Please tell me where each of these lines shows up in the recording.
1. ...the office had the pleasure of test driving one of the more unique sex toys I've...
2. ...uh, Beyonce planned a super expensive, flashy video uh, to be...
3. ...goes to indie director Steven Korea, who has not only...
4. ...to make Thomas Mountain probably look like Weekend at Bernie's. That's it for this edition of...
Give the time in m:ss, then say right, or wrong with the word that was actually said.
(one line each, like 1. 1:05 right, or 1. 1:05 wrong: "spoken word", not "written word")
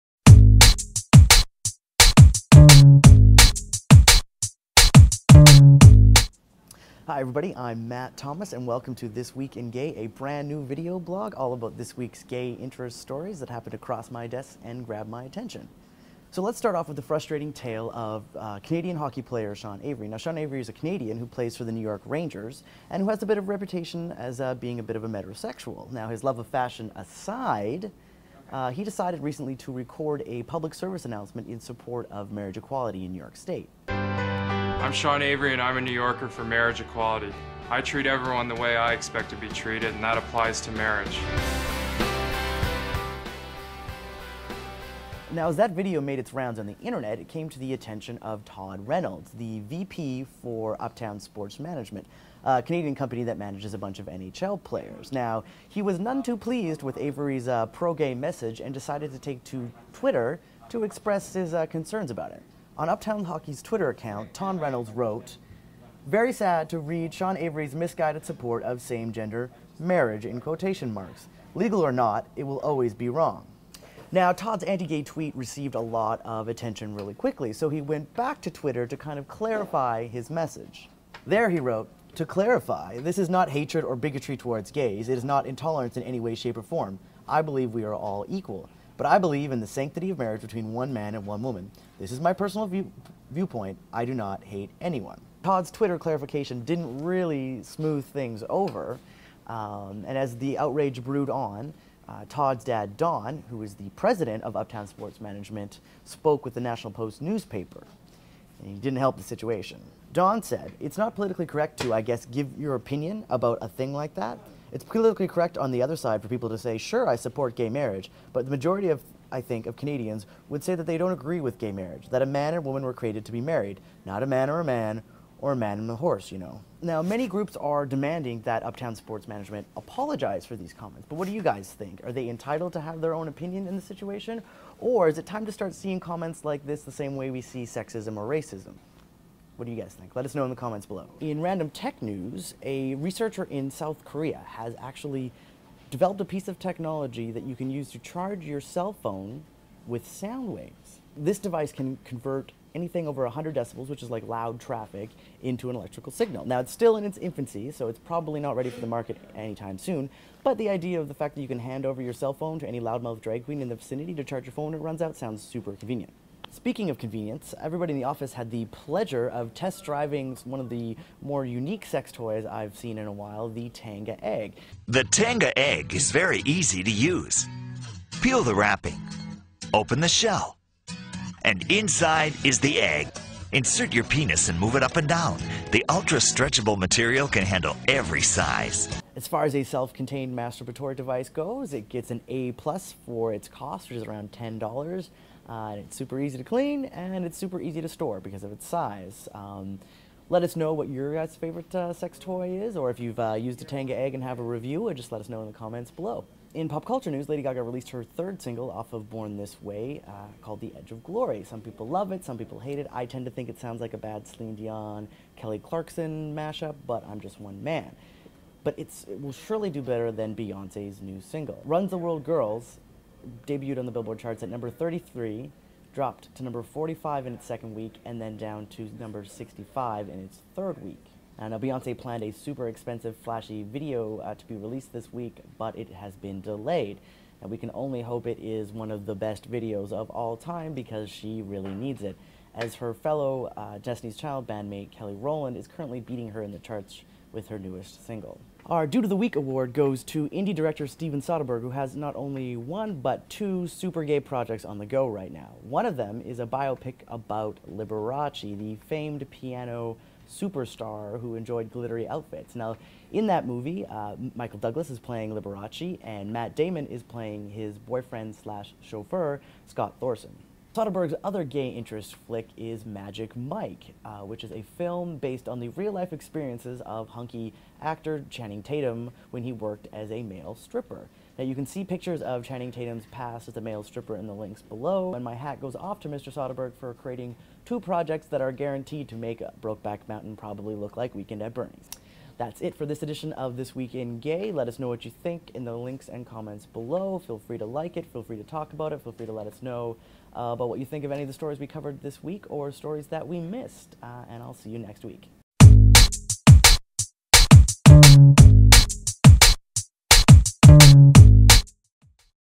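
1. 2:47 right
2. 3:51 right
3. 4:09 wrong: "Soderbergh", not "Korea"
4. 4:49 wrong: "Brokeback", not "Thomas".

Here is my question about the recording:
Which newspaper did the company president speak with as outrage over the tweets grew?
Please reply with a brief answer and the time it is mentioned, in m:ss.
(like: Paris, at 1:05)
National Post, at 1:46.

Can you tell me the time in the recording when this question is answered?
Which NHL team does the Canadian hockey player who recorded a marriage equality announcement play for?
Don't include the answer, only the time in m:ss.
0:21.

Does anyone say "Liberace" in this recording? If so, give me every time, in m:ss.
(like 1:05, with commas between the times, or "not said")
4:17, 4:25.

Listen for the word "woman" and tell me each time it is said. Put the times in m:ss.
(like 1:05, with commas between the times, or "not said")
1:31, 2:02.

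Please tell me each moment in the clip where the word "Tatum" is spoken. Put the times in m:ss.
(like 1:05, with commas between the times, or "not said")
4:38, 4:42.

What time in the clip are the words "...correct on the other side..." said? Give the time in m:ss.
1:55.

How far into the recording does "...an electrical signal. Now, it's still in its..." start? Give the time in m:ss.
2:35.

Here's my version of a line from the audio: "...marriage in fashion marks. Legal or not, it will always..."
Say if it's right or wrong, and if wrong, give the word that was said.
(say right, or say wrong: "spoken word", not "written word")
wrong: "quotation", not "fashion".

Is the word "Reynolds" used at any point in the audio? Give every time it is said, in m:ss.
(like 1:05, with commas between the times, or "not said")
0:48, 1:04.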